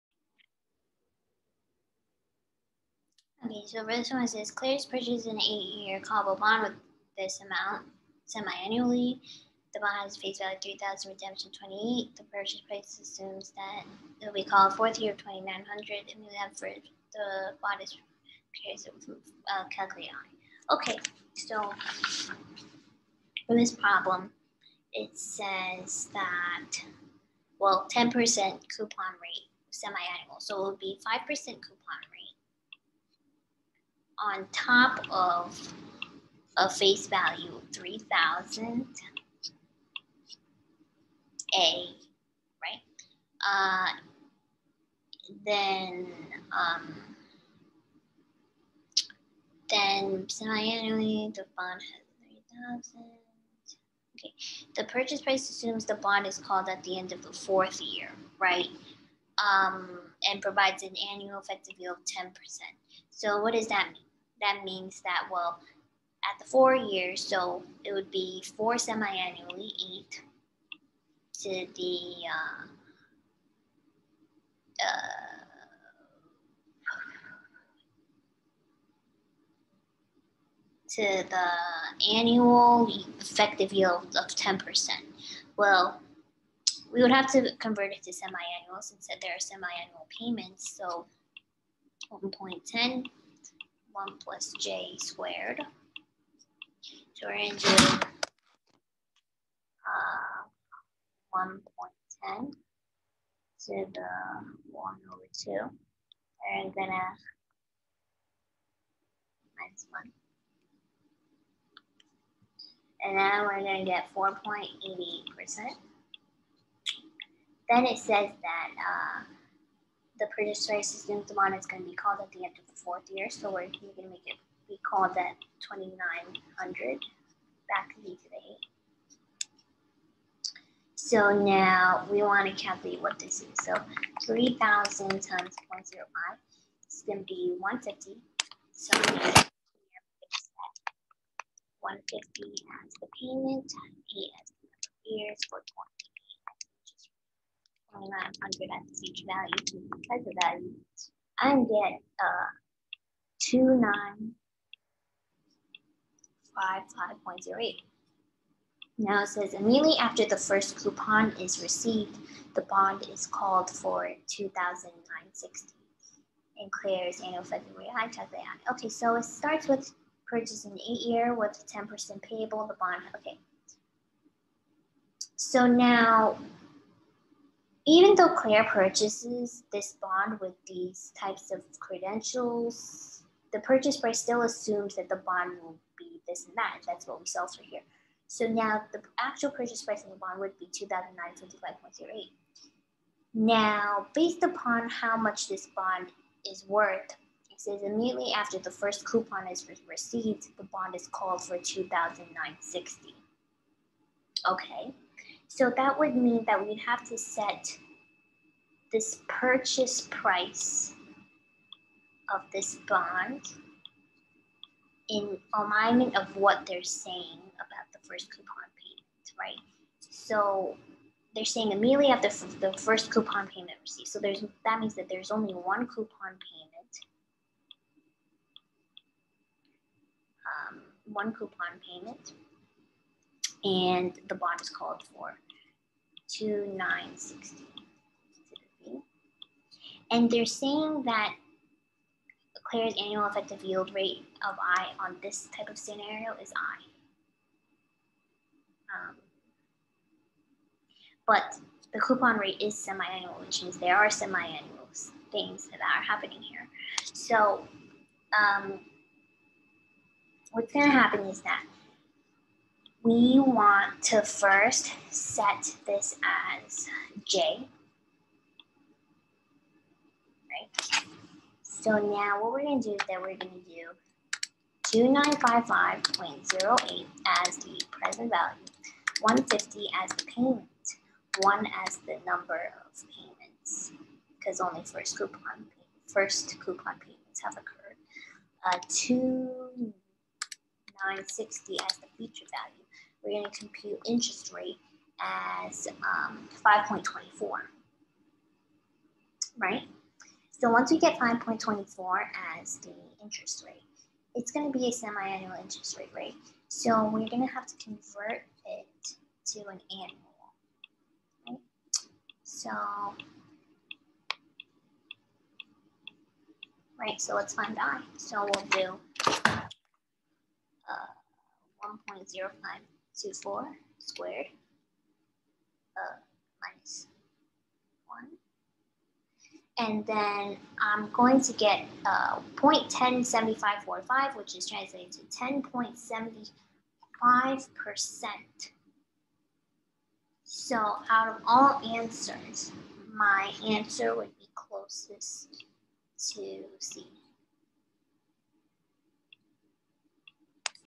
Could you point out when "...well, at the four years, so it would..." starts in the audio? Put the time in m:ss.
1:05.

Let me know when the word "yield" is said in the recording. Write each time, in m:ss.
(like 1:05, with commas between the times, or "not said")
1:01, 1:23, 4:03.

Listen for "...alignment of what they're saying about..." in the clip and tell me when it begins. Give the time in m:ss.
3:35.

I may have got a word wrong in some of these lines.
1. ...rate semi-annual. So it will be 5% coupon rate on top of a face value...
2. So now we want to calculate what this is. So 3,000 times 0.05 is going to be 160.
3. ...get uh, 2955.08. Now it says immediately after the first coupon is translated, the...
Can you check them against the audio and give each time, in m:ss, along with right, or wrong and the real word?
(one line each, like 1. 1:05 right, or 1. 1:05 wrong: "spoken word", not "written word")
1. 0:29 right
2. 2:10 wrong: "150", not "160"
3. 2:31 wrong: "received", not "translated".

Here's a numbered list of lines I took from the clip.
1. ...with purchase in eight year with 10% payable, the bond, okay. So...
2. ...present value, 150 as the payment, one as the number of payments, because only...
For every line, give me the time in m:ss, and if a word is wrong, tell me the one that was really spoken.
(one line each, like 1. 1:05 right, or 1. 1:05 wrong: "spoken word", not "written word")
1. 2:49 right
2. 4:37 right.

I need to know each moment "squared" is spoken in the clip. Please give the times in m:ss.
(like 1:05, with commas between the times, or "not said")
1:34, 5:23.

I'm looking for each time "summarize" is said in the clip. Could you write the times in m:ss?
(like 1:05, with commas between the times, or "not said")
not said.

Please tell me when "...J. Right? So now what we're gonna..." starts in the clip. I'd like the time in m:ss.
4:27.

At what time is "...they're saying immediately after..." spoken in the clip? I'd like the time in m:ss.
3:41.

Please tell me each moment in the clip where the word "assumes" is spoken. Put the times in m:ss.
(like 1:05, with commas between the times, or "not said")
0:13, 0:55, 3:04.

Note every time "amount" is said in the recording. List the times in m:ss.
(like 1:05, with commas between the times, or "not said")
0:07, 2:01.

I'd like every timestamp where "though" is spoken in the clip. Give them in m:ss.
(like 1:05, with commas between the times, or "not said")
2:58.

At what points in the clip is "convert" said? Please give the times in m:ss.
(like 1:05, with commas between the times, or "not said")
1:27, 5:07.